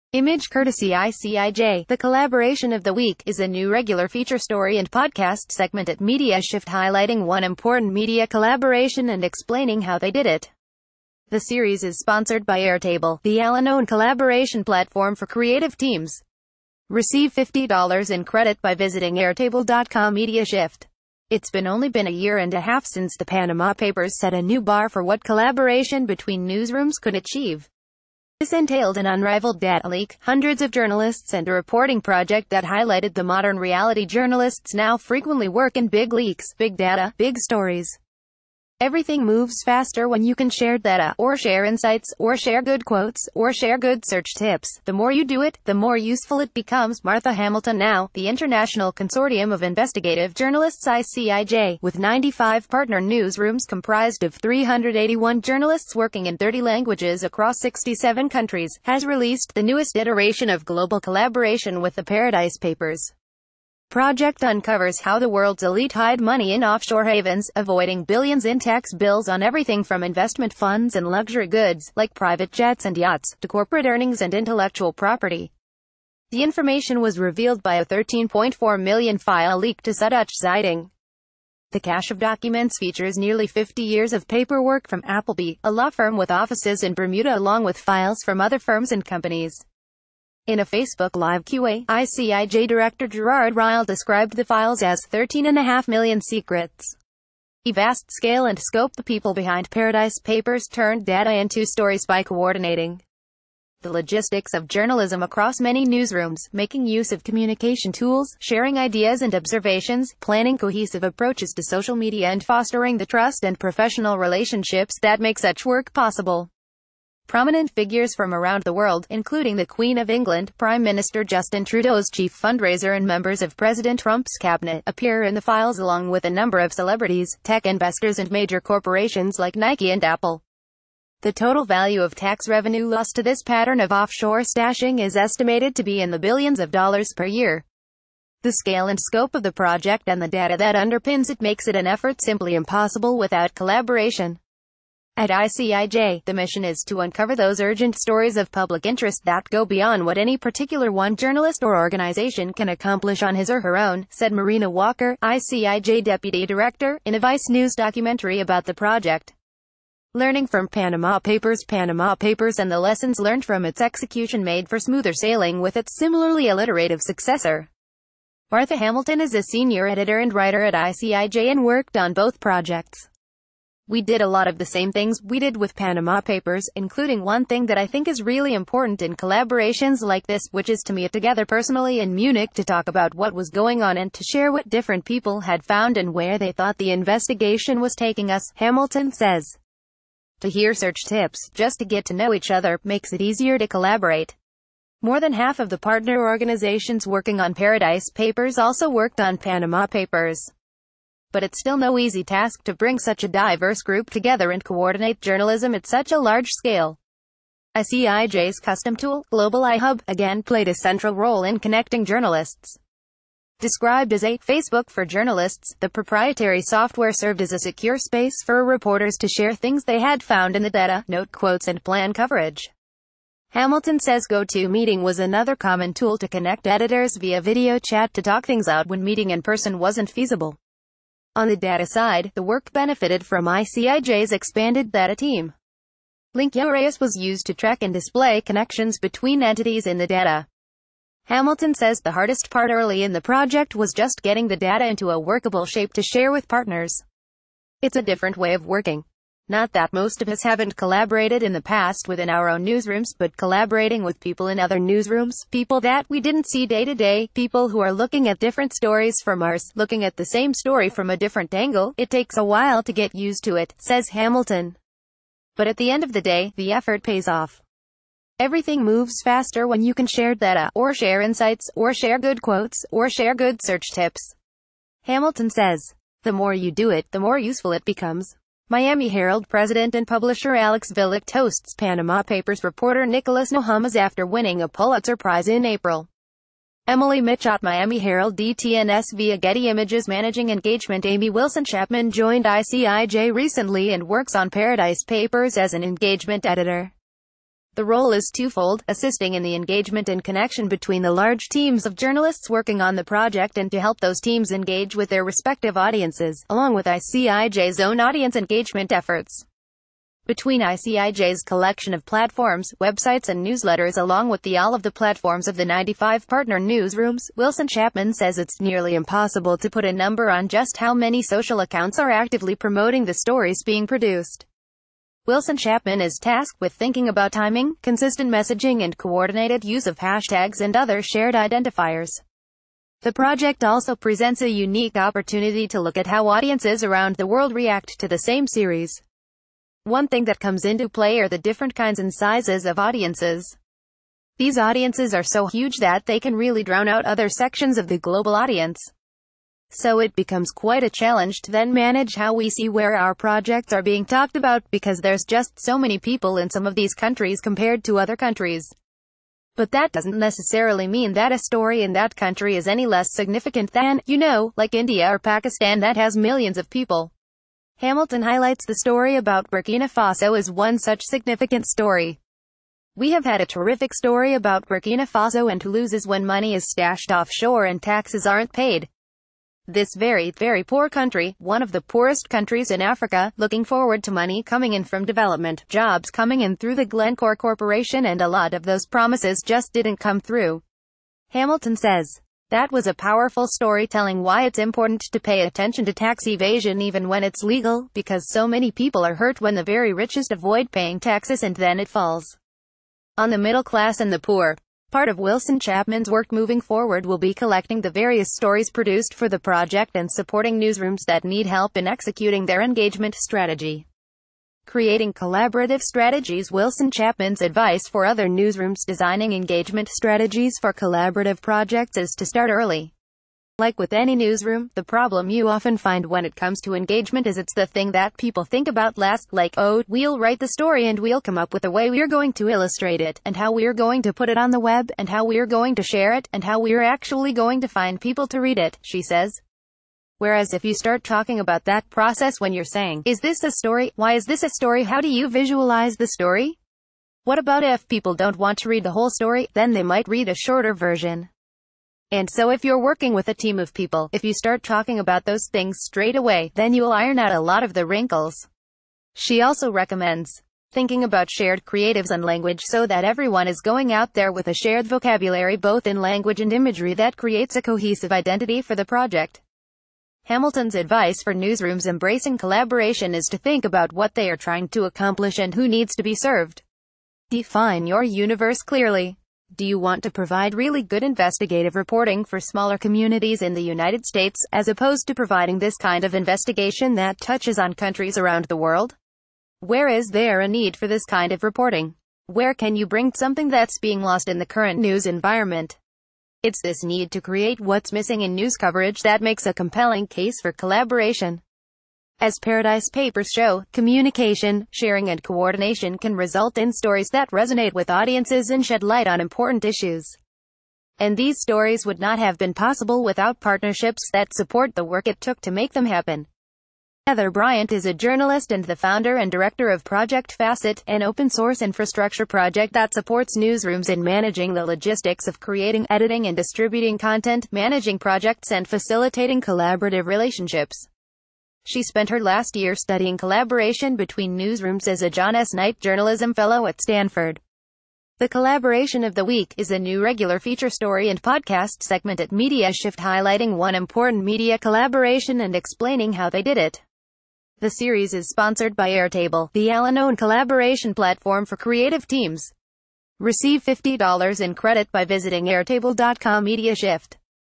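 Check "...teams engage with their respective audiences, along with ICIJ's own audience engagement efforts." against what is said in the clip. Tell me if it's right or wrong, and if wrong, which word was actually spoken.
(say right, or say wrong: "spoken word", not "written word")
right.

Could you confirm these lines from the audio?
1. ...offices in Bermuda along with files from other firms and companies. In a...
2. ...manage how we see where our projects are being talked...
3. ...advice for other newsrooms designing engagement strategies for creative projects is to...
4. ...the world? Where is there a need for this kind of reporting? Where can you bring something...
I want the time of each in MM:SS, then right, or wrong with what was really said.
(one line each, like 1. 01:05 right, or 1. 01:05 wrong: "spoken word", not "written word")
1. 01:26 right
2. 05:51 right
3. 06:57 wrong: "collaborative", not "creative"
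4. 08:08 right.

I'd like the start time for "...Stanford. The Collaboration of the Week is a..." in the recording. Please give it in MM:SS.
08:56.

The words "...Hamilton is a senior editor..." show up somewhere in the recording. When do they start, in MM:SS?
02:48.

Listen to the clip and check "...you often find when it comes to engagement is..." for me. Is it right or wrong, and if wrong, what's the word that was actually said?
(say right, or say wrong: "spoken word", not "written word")
right.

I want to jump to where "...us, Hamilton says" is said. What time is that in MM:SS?
03:08.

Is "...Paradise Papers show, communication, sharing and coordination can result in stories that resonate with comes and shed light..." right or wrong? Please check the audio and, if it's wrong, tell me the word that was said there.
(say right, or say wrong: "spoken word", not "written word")
wrong: "audiences", not "comes".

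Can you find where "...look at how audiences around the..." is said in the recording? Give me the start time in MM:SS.
05:35.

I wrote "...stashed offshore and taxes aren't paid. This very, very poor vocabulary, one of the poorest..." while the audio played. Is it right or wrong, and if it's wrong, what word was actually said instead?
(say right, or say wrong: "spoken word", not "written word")
wrong: "country", not "vocabulary".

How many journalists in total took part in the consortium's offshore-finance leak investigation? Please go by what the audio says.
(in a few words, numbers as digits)
381.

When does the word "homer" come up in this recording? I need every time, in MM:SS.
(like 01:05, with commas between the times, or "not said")
not said.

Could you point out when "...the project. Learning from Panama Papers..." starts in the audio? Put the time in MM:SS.
02:38.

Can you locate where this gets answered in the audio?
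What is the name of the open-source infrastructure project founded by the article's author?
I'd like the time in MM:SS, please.
08:39.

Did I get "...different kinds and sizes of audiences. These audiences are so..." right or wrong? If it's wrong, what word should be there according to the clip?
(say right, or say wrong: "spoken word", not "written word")
right.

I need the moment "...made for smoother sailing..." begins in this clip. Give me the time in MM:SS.
02:44.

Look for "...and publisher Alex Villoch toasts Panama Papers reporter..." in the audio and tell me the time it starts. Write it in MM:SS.
04:39.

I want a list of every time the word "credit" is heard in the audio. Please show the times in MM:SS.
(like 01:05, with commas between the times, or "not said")
00:18, 09:14.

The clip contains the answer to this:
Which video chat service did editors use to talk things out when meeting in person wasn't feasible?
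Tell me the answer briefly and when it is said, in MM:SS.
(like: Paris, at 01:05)
GoToMeeting, at 03:44.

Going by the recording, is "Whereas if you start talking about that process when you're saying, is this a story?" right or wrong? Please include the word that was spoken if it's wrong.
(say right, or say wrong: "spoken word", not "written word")
right.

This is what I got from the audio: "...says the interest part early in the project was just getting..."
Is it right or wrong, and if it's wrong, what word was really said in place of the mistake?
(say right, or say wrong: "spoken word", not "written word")
wrong: "hardest", not "interest".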